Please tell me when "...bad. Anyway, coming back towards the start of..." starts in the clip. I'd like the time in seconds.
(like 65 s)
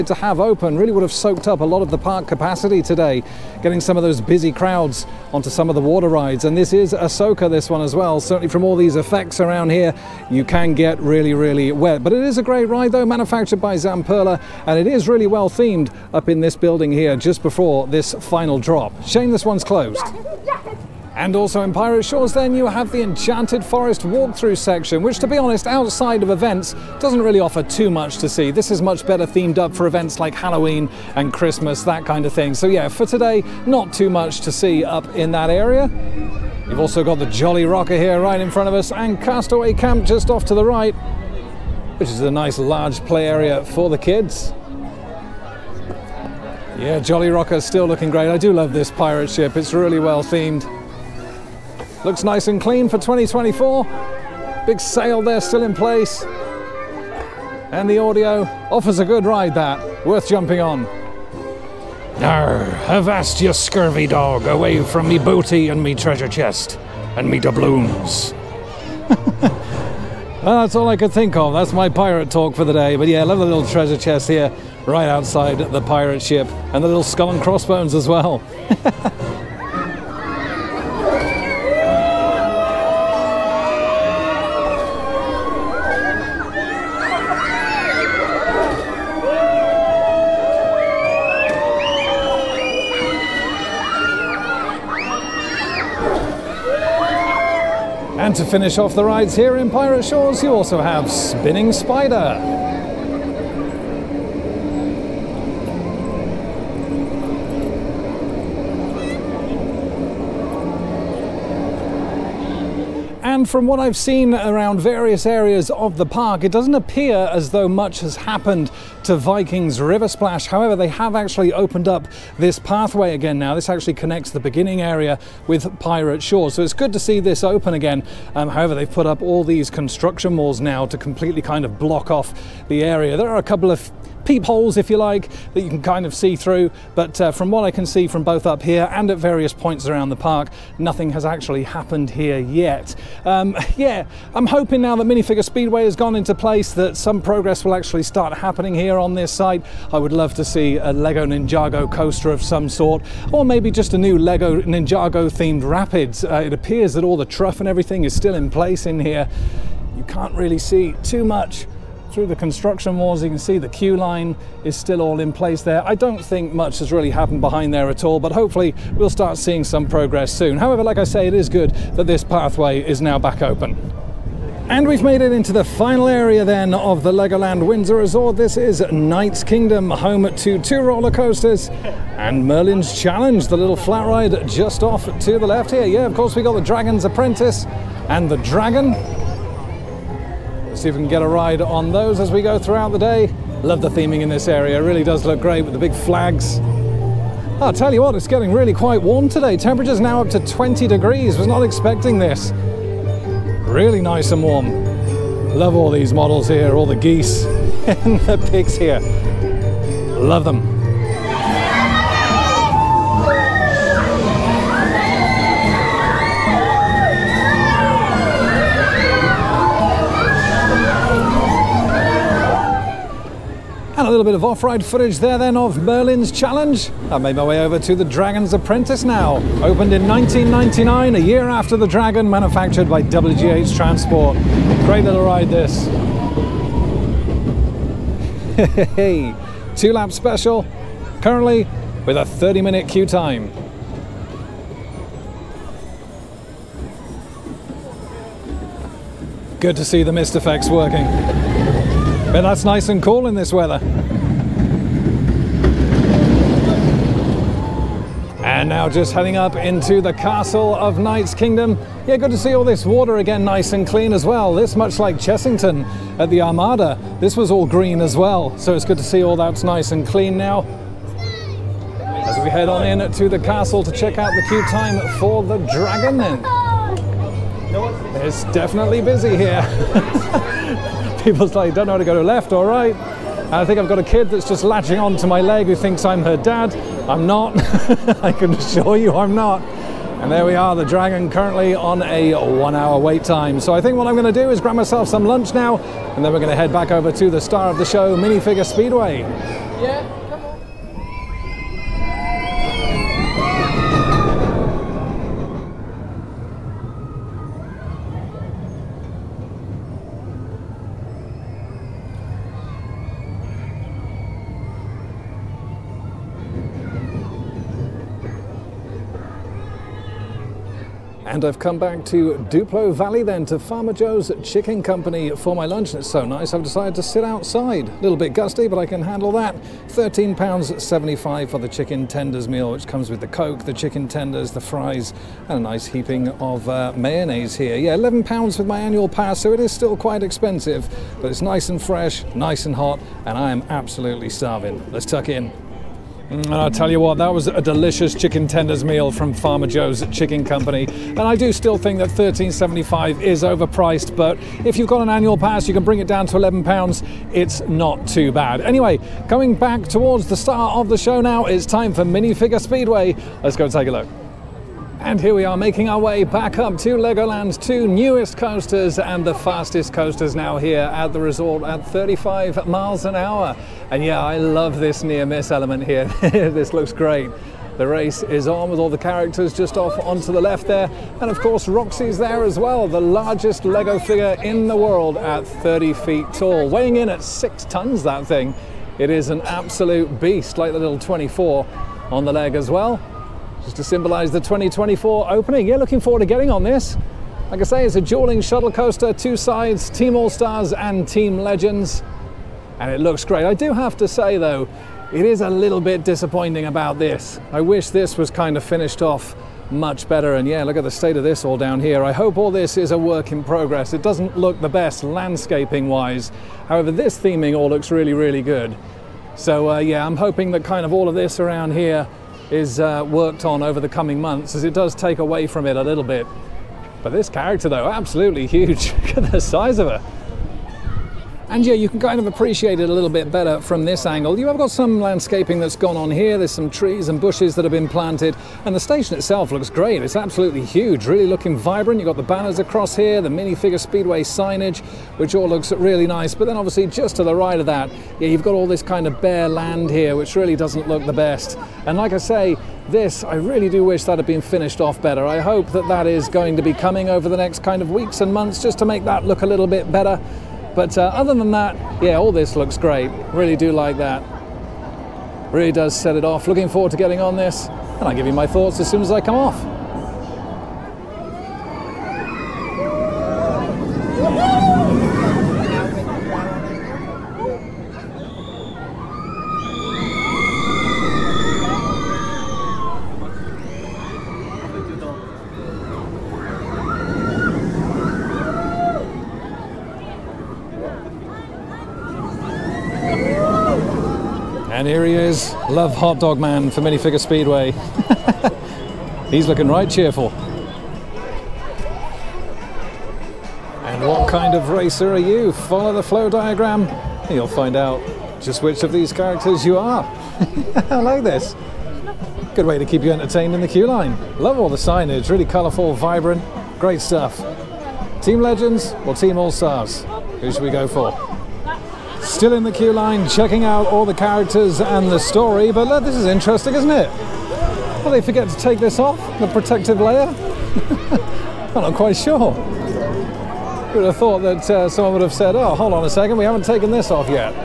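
358 s.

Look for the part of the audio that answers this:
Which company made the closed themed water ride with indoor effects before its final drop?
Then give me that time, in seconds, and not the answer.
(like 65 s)
13 s.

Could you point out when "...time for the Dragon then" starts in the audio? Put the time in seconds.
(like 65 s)
274 s.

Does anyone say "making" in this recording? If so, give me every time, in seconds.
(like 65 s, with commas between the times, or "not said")
365 s.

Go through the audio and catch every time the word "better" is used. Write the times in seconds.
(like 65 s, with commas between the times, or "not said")
29 s, 410 s, 433 s, 455 s, 459 s.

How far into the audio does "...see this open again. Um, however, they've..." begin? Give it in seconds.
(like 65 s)
126 s.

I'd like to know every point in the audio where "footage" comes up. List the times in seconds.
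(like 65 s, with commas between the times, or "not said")
224 s.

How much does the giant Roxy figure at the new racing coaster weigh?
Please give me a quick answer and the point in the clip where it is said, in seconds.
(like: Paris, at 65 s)
6 tons, at 387 s.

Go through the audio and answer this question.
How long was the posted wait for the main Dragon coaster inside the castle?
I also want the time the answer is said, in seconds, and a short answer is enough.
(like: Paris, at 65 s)
1 hour, at 292 s.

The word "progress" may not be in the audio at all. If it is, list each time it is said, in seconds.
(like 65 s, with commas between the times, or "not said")
147 s, 169 s, 413 s.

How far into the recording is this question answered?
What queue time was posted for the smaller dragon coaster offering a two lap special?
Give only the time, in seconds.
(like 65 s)
242 s.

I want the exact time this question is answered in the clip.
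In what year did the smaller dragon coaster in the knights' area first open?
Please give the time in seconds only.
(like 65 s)
230 s.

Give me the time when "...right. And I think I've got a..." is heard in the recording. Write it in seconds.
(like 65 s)
282 s.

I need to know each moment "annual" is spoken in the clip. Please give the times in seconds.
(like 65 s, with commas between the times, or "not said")
338 s, 355 s.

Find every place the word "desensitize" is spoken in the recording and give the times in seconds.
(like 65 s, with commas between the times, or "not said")
not said.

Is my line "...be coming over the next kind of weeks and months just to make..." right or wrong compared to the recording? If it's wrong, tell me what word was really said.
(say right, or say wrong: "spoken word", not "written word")
right.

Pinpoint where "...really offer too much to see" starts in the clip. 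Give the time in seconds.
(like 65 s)
27 s.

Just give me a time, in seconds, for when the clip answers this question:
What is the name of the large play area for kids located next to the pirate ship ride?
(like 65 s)
39 s.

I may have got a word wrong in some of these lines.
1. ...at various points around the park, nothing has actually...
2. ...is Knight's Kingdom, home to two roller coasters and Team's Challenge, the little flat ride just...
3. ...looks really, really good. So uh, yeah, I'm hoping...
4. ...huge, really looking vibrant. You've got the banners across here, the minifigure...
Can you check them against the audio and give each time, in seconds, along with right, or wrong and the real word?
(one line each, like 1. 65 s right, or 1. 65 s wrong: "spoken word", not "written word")
1. 139 s right
2. 178 s wrong: "Merlin", not "Team"
3. 417 s right
4. 440 s right.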